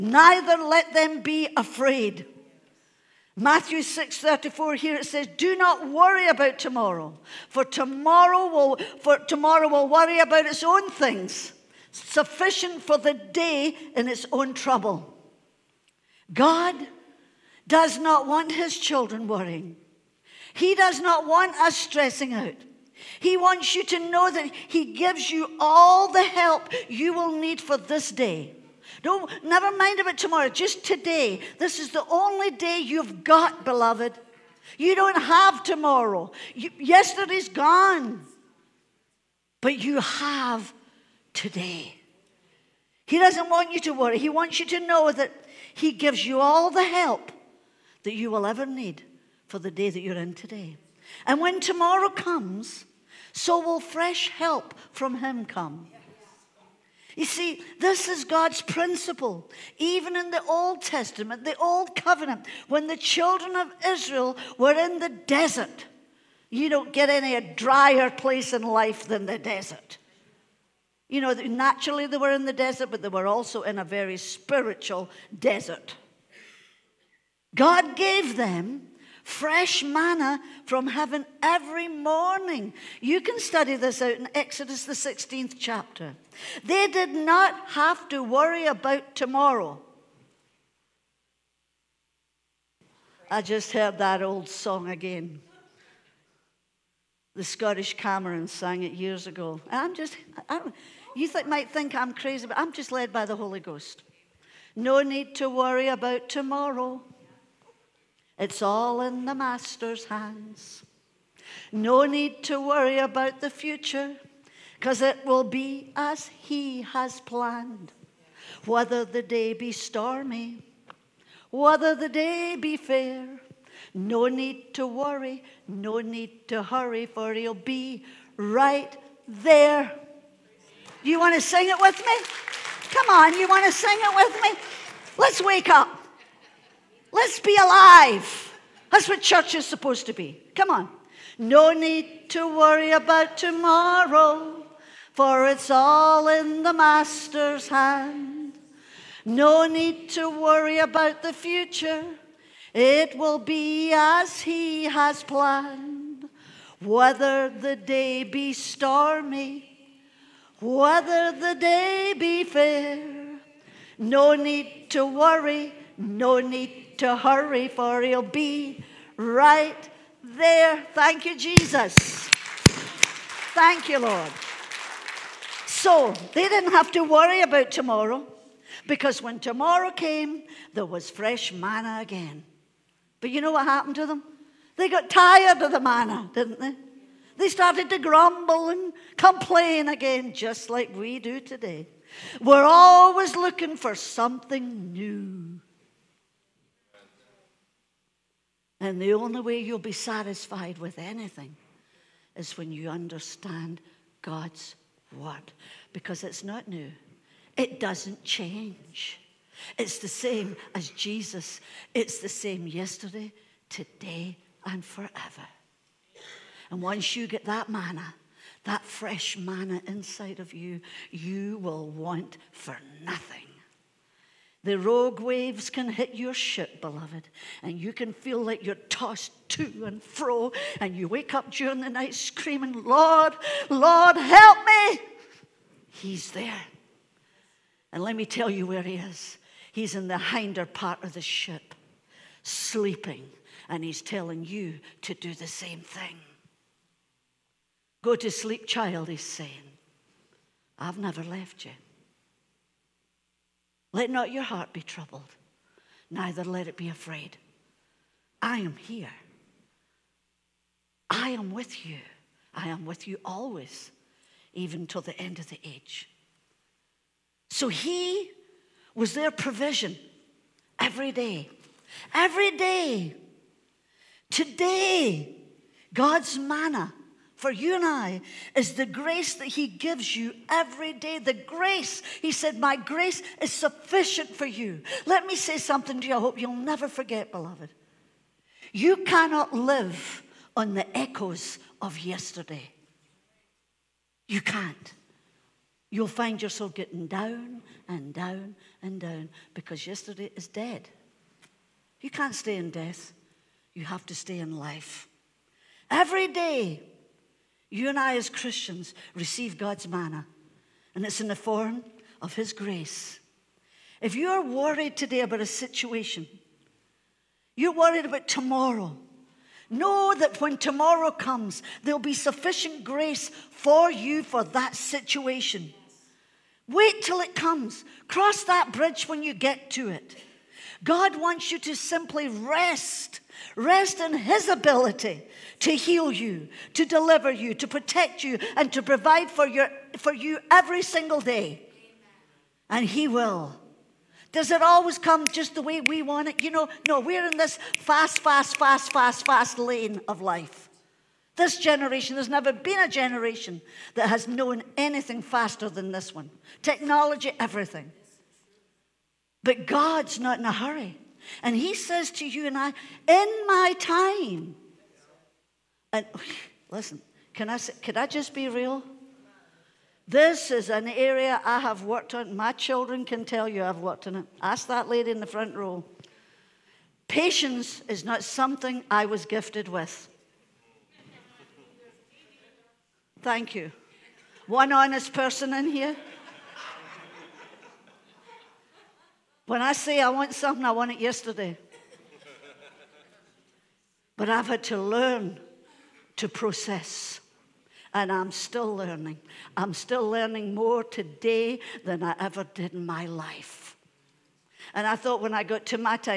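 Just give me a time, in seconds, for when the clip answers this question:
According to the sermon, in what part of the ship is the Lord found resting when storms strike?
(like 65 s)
240 s.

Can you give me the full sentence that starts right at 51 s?
And when tomorrow comes, so will fresh help from him come.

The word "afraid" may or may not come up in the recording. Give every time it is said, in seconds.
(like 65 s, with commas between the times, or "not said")
1 s, 256 s.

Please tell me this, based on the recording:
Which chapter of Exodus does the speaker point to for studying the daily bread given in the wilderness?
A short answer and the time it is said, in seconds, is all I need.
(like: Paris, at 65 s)
16th chapter, at 84 s.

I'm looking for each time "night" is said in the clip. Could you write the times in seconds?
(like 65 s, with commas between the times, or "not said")
231 s.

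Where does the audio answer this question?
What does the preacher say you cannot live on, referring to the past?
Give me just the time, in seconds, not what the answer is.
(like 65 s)
290 s.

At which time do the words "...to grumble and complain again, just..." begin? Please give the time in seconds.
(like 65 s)
187 s.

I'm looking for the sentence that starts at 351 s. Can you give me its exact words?
This generation, there's never been a generation that has known anything faster than this one.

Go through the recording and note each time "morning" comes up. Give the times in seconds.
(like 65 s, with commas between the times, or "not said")
81 s.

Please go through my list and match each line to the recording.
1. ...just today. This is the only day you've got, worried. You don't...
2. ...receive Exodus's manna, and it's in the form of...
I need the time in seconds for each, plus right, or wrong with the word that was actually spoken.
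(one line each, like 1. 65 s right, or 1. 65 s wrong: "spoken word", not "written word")
1. 30 s wrong: "beloved", not "worried"
2. 309 s wrong: "God", not "Exodus".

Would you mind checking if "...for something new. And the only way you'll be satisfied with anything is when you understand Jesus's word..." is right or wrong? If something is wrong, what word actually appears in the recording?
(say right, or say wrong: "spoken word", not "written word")
wrong: "God", not "Jesus".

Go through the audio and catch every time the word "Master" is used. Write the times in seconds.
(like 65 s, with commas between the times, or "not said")
109 s, 146 s.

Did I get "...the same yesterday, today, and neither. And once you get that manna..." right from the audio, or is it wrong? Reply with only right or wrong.
wrong.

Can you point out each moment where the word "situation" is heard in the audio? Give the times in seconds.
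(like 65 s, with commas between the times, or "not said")
315 s, 324 s.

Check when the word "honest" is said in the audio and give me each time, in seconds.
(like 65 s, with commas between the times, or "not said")
384 s.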